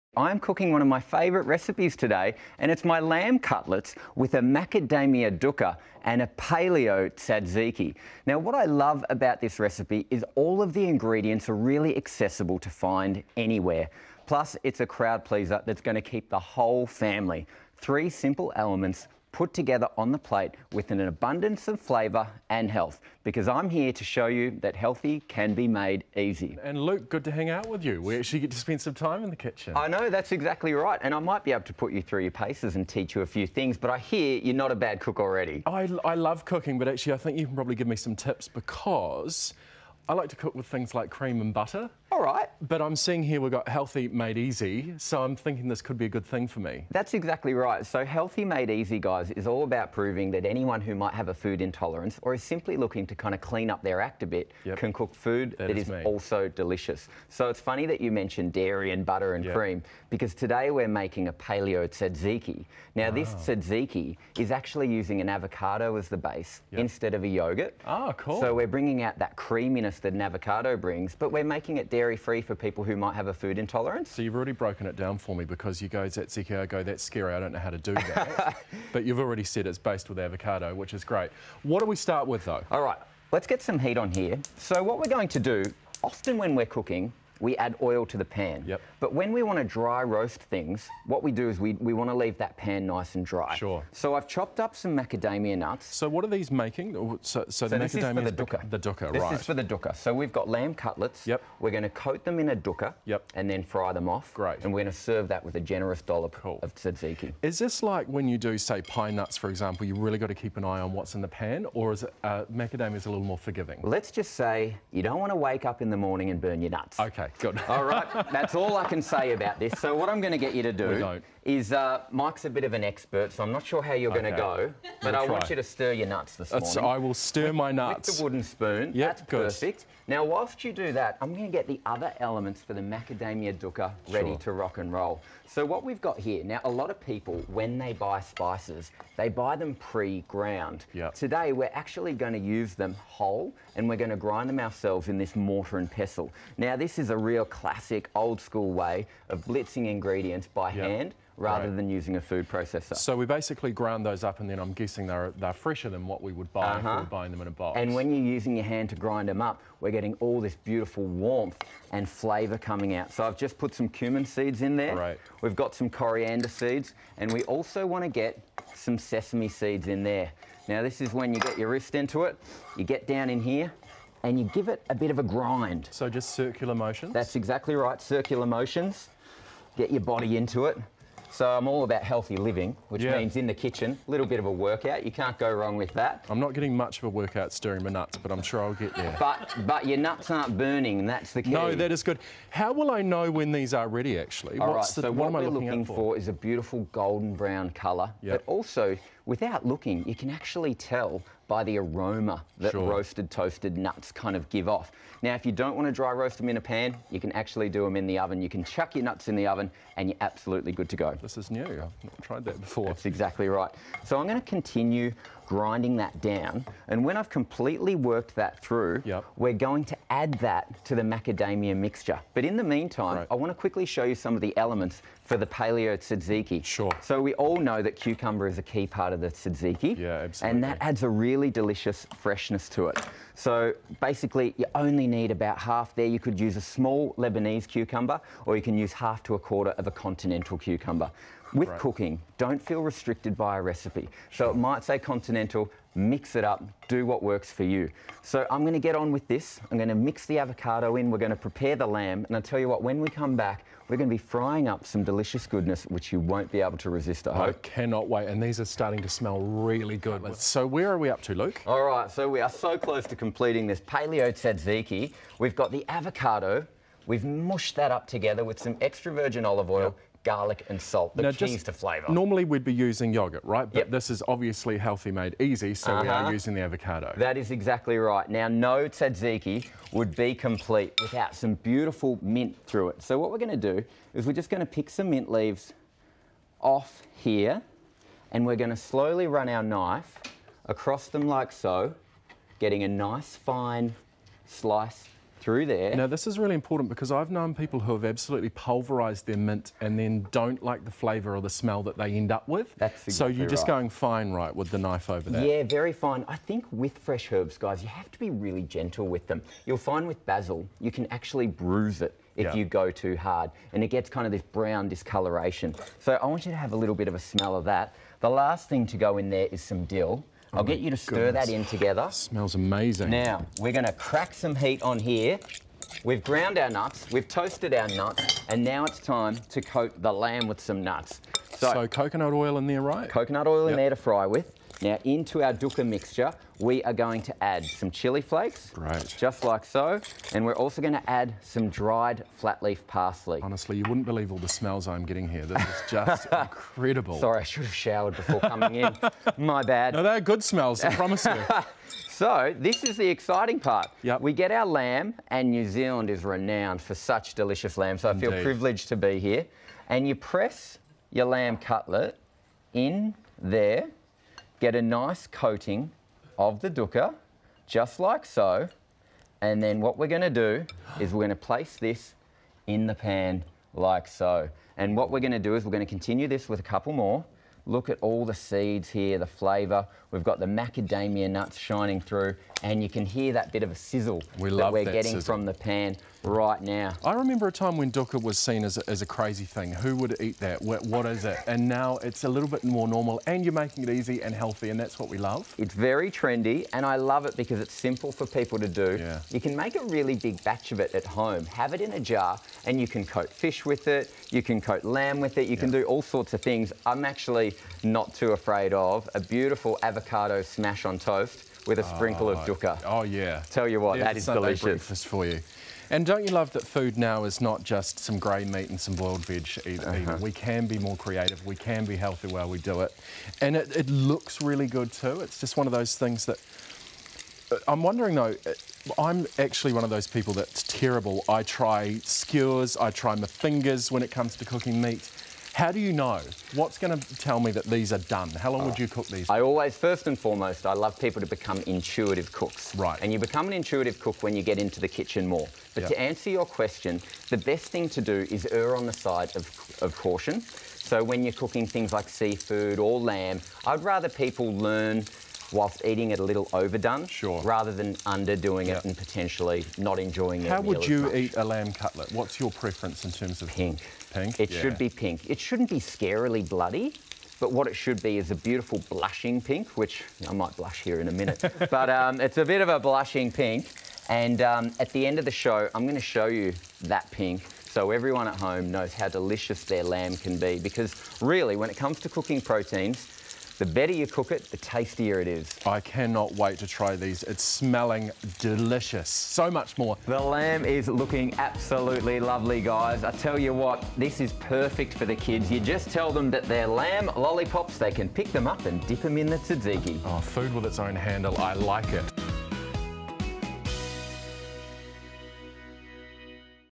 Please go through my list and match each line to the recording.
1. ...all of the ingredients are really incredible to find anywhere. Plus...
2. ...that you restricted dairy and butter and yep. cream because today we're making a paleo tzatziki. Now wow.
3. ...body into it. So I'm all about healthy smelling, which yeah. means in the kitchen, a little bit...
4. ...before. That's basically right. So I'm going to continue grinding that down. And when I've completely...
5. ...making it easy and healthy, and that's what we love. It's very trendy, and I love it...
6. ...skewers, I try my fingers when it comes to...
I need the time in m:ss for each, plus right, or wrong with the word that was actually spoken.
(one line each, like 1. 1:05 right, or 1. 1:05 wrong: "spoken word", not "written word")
1. 0:10 wrong: "accessible", not "incredible"
2. 0:57 wrong: "mentioned", not "restricted"
3. 3:00 wrong: "living", not "smelling"
4. 3:32 wrong: "exactly", not "basically"
5. 6:33 right
6. 7:12 right.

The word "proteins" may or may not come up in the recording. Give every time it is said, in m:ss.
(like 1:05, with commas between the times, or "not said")
8:02.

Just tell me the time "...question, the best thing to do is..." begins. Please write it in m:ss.
7:26.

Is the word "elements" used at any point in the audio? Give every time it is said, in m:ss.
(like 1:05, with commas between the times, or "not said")
0:18, 2:12, 3:44.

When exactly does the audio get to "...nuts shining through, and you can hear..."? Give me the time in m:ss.
6:21.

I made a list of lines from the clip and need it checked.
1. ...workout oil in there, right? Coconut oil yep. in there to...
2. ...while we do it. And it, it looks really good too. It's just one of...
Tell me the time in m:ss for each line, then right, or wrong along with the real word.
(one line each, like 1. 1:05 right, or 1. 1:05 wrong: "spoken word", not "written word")
1. 5:31 wrong: "coconut", not "workout"
2. 7:02 right.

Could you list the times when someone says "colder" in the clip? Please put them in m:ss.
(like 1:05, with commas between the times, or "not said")
not said.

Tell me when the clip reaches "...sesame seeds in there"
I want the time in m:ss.
2:48.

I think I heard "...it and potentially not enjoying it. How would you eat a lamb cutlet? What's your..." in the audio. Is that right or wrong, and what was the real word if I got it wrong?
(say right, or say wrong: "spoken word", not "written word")
right.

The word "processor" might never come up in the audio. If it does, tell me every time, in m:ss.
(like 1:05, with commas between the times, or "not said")
2:32.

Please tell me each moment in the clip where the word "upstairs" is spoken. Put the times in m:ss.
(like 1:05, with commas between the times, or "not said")
not said.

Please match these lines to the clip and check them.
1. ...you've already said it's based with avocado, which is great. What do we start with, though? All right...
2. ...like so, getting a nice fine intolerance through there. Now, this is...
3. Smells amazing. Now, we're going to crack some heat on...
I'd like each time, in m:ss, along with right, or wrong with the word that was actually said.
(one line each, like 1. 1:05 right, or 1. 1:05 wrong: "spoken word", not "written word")
1. 1:19 right
2. 4:51 wrong: "slice", not "intolerance"
3. 5:22 right.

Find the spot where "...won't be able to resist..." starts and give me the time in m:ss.
4:16.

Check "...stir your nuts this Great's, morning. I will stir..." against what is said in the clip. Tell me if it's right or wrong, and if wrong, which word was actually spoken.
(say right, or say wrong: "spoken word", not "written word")
wrong: "That", not "Great".